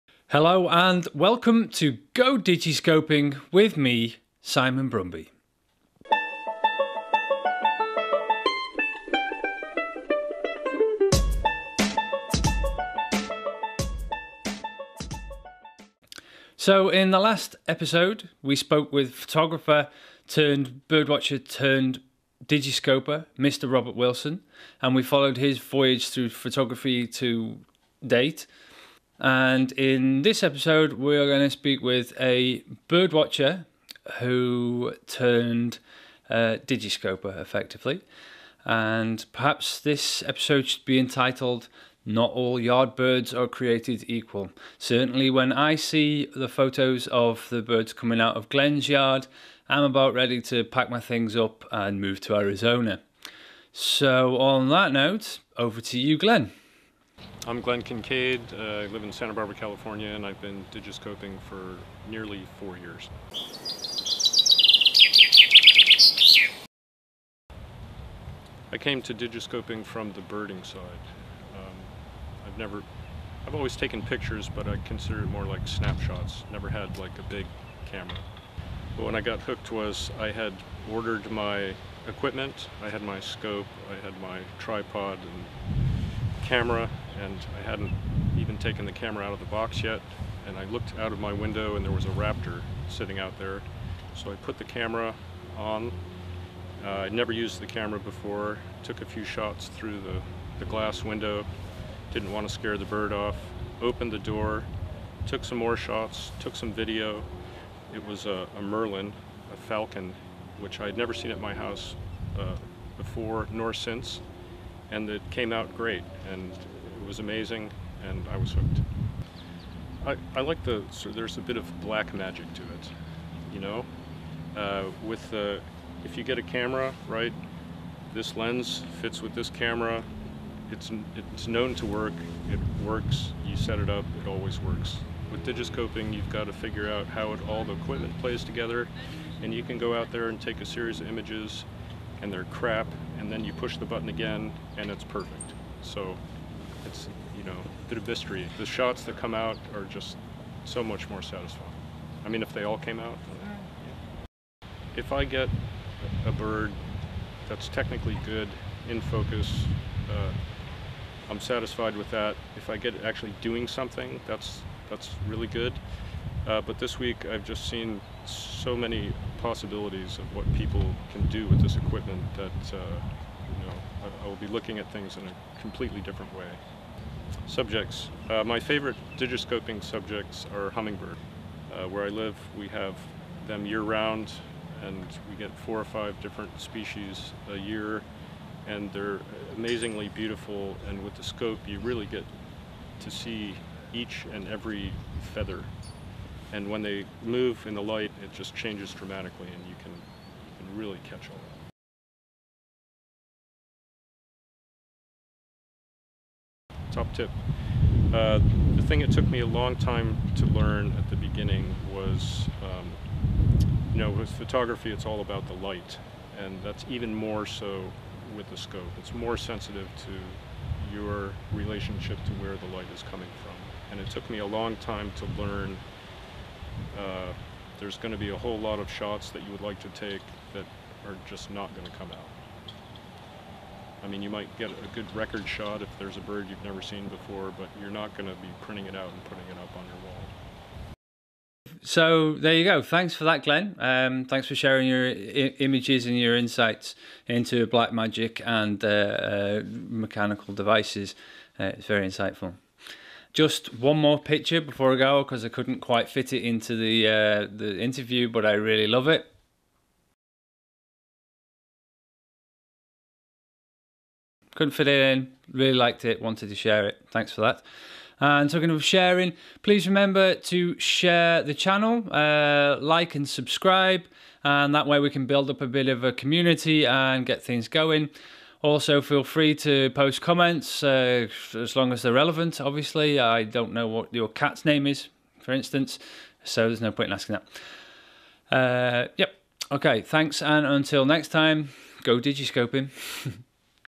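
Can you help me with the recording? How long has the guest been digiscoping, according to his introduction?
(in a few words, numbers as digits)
Nearly 4 years.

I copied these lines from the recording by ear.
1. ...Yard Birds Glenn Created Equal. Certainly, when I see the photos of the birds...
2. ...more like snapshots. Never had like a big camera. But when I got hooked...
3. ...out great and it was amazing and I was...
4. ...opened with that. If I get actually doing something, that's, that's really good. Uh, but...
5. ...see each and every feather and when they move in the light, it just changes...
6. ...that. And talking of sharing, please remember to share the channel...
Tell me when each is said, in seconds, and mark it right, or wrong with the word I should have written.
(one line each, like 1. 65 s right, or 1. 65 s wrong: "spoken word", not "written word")
1. 42 s wrong: "Are", not "Glenn"
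2. 75 s right
3. 115 s right
4. 161 s wrong: "satisfied", not "opened"
5. 193 s right
6. 267 s right.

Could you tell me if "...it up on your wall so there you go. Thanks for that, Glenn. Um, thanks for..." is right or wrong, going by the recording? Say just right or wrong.
right.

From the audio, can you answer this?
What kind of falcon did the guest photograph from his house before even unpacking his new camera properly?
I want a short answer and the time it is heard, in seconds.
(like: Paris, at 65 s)
Merlin, at 108 s.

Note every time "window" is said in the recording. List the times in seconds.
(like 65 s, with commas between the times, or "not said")
91 s, 101 s.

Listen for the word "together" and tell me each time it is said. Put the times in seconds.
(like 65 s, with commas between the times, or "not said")
138 s.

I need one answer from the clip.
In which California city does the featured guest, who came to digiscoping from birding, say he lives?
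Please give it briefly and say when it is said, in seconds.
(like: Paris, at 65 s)
Santa Barbara, at 59 s.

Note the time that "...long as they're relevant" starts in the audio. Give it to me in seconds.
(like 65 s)
281 s.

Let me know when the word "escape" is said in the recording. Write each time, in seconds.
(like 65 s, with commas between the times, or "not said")
not said.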